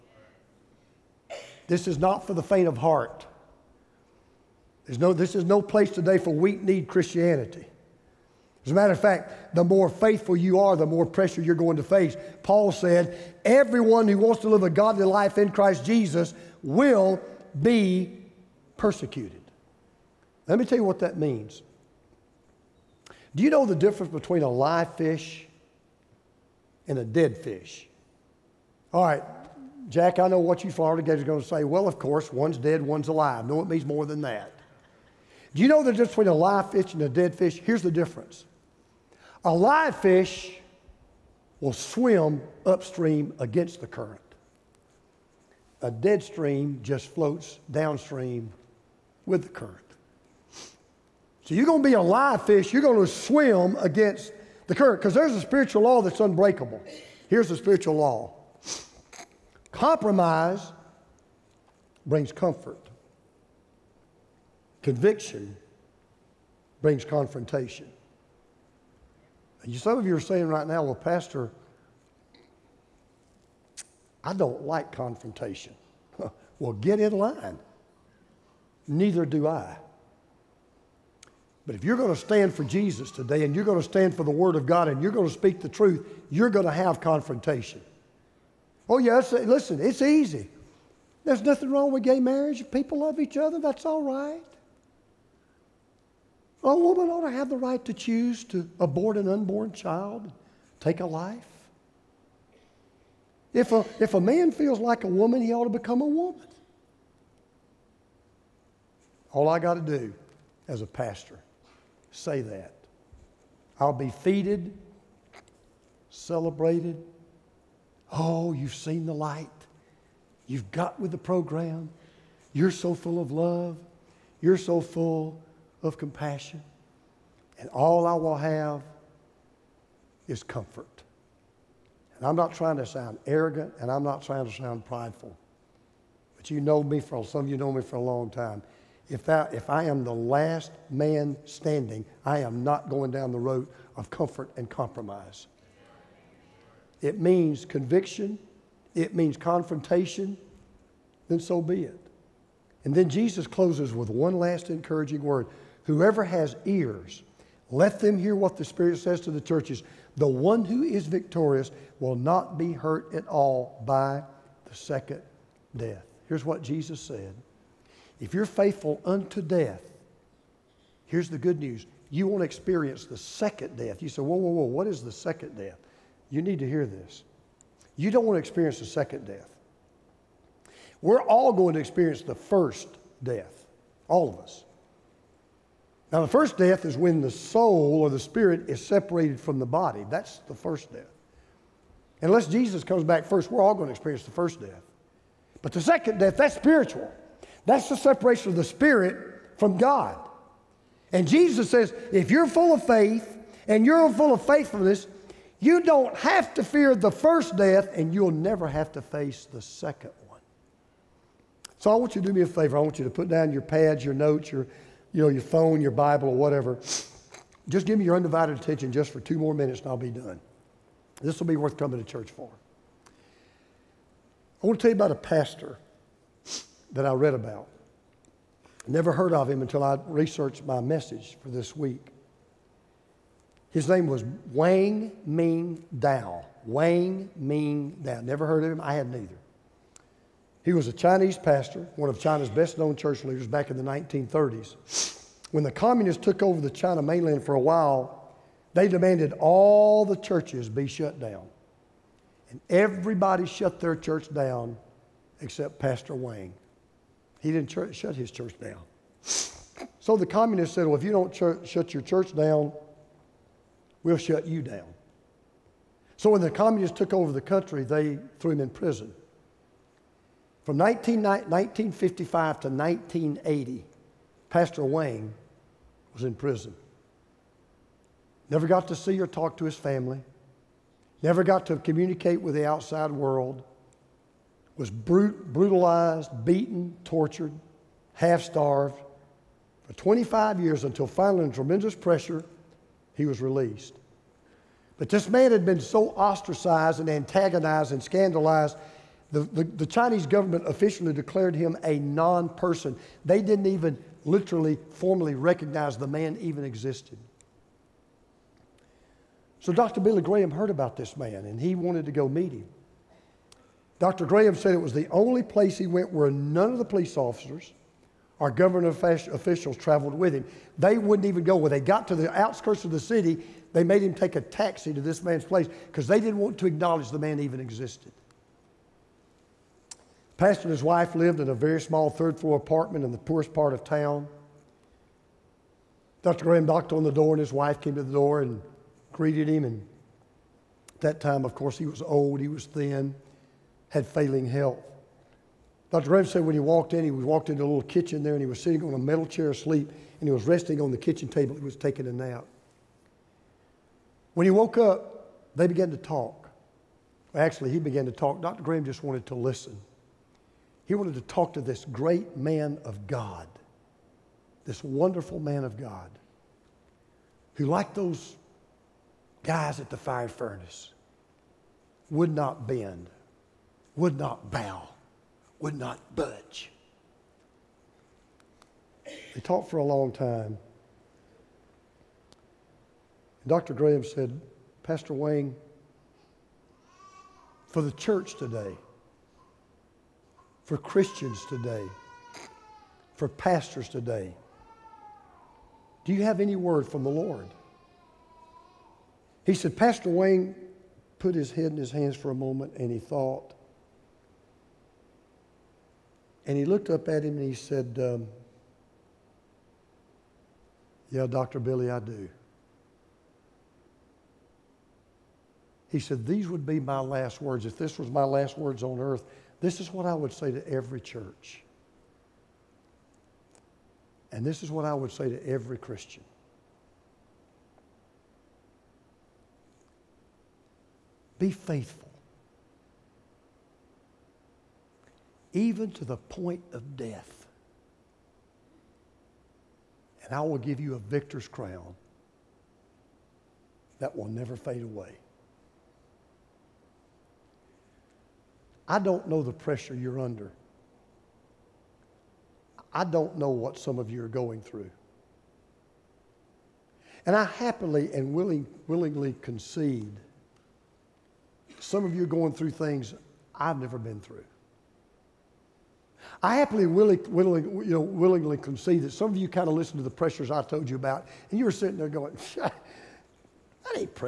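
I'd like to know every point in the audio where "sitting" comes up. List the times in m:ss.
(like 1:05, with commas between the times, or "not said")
5:48, 7:51.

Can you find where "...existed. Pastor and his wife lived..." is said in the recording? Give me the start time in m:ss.
5:27.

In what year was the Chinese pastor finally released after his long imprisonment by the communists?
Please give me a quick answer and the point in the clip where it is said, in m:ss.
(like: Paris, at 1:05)
1980, at 4:32.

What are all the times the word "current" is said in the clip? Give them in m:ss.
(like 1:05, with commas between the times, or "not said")
0:43, 0:49, 0:54.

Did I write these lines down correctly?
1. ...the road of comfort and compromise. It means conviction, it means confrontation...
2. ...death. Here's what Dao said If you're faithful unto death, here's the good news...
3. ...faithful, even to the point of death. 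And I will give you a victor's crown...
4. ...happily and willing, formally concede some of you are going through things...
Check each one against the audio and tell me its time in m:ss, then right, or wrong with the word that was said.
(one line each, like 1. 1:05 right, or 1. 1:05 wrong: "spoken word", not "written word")
1. 2:23 right
2. 2:45 wrong: "Jesus", not "Dao"
3. 7:11 right
4. 7:37 wrong: "willingly", not "formally".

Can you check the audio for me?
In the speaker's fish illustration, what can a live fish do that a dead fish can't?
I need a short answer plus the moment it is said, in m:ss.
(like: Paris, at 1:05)
Swim upstream, at 0:41.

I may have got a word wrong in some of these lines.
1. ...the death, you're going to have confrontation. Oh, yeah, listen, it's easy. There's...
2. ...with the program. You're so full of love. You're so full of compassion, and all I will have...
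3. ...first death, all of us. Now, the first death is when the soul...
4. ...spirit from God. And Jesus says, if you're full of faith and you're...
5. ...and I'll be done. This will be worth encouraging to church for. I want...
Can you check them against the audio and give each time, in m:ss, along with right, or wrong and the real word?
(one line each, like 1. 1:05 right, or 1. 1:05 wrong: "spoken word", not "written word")
1. 1:25 wrong: "truth", not "death"
2. 2:00 right
3. 3:02 right
4. 3:18 right
5. 3:39 wrong: "coming", not "encouraging".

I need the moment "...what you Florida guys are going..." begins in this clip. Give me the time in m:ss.
0:30.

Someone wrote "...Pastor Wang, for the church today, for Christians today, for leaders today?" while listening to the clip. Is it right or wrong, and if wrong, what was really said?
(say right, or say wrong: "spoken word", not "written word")
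wrong: "pastors", not "leaders".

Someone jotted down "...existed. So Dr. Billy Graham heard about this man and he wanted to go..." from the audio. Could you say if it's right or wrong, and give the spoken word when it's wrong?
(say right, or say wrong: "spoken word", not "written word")
right.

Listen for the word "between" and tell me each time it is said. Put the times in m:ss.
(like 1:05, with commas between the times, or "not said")
0:24, 0:36.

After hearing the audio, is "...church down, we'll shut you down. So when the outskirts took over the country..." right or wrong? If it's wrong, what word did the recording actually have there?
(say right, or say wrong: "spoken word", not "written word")
wrong: "communists", not "outskirts".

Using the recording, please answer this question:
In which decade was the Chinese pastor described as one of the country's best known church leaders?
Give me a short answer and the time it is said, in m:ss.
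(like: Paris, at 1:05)
1930s, at 4:03.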